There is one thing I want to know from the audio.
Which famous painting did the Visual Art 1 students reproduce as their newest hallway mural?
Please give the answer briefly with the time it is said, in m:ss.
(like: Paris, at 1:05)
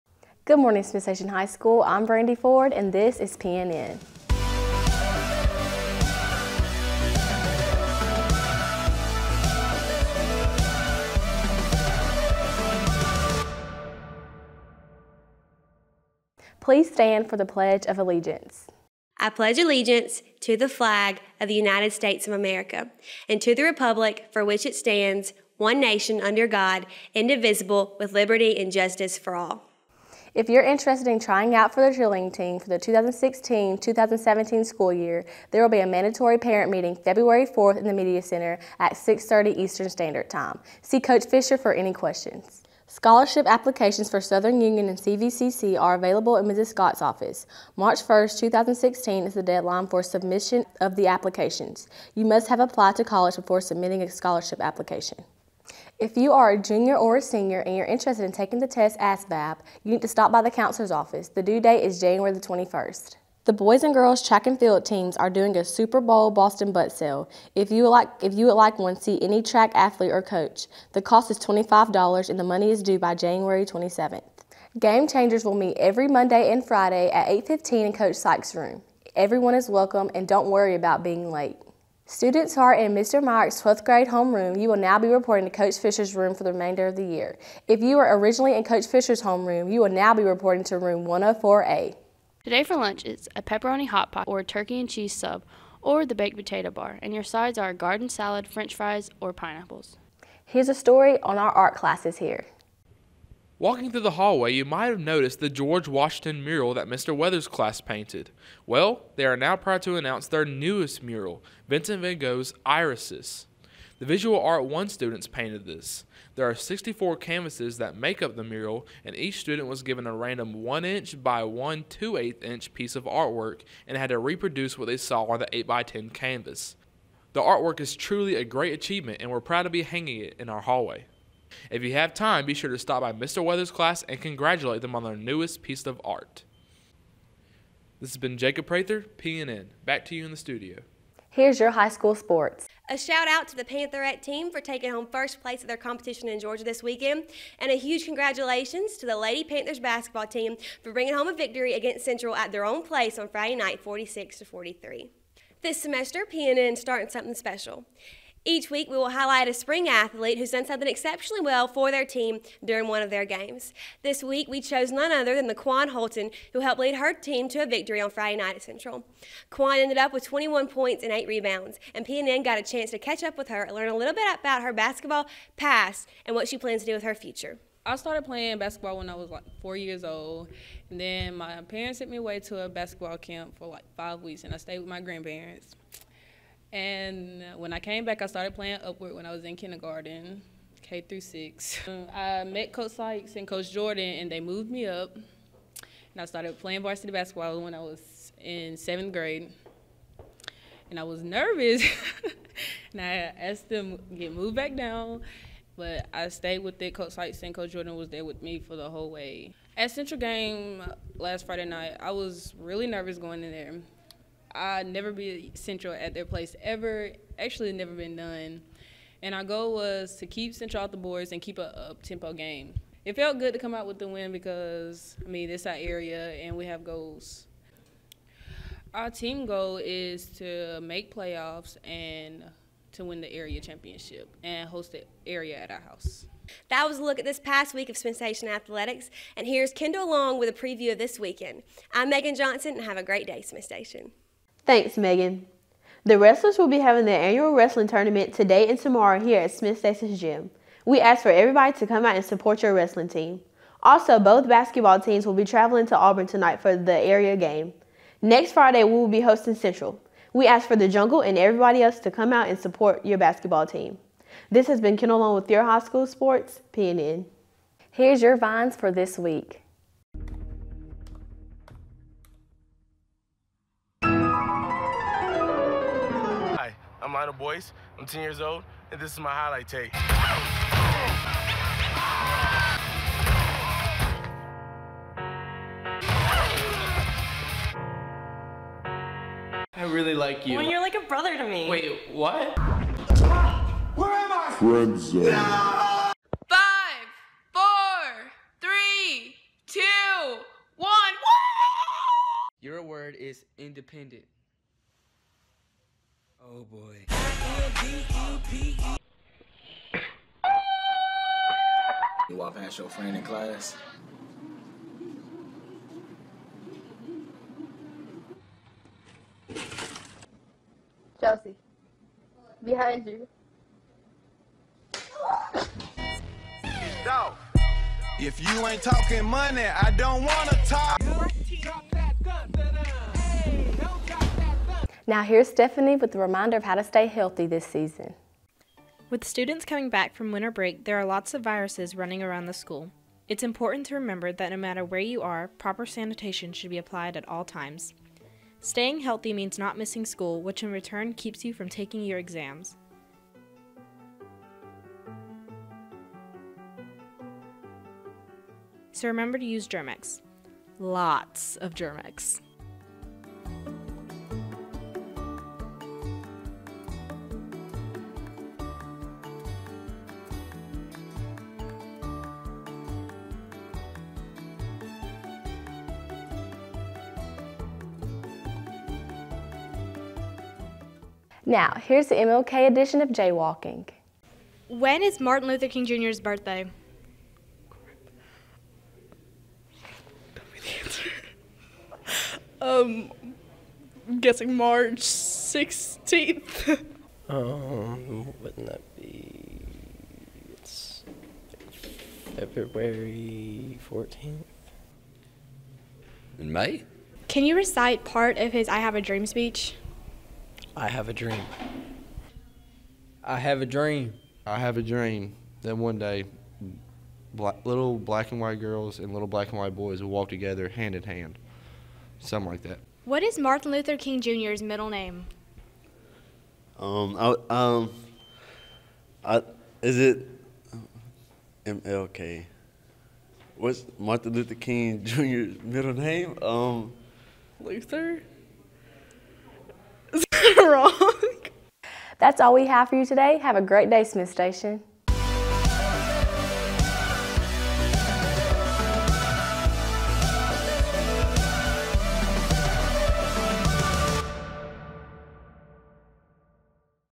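Irises, at 1:52.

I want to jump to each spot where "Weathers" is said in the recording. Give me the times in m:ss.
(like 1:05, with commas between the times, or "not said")
1:47, 2:13.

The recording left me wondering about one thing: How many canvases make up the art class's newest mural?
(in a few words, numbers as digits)
64.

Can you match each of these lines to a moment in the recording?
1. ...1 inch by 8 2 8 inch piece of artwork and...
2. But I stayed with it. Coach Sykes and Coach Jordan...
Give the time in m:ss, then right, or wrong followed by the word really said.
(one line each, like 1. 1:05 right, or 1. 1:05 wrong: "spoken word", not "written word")
1. 2:00 wrong: "1", not "8"
2. 3:25 right.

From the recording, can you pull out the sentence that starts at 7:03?
What is Martin Luther King Jr.'s middle name?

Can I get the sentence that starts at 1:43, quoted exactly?
Walking through the hallway, you might have noticed the George Washington mural that Mr.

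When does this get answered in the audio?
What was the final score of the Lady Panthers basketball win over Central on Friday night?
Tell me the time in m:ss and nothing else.
2:33.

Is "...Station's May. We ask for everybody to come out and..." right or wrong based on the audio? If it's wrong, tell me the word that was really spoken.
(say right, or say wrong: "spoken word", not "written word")
wrong: "Gym", not "May".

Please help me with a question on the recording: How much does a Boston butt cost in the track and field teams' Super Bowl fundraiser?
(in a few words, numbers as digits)
$25.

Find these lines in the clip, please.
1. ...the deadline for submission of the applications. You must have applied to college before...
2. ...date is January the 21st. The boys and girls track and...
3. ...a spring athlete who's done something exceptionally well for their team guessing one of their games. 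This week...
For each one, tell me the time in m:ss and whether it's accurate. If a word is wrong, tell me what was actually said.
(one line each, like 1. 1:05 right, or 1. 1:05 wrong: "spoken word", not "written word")
1. 0:49 right
2. 1:01 right
3. 2:39 wrong: "during", not "guessing".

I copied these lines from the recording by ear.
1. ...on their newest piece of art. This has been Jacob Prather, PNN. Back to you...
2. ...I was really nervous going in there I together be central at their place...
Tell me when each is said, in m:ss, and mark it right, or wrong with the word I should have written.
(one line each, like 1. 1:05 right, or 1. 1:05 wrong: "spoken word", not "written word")
1. 2:14 right
2. 3:31 wrong: "never", not "together".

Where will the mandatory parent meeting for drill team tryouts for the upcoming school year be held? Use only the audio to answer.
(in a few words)
Media Center.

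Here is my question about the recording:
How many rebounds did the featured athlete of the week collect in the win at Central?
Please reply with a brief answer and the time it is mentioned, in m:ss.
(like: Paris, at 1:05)
8, at 2:51.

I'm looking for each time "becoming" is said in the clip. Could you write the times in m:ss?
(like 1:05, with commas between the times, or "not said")
not said.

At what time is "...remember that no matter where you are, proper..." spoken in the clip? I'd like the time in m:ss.
5:43.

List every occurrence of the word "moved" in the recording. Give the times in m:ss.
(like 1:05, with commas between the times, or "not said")
3:14, 3:24.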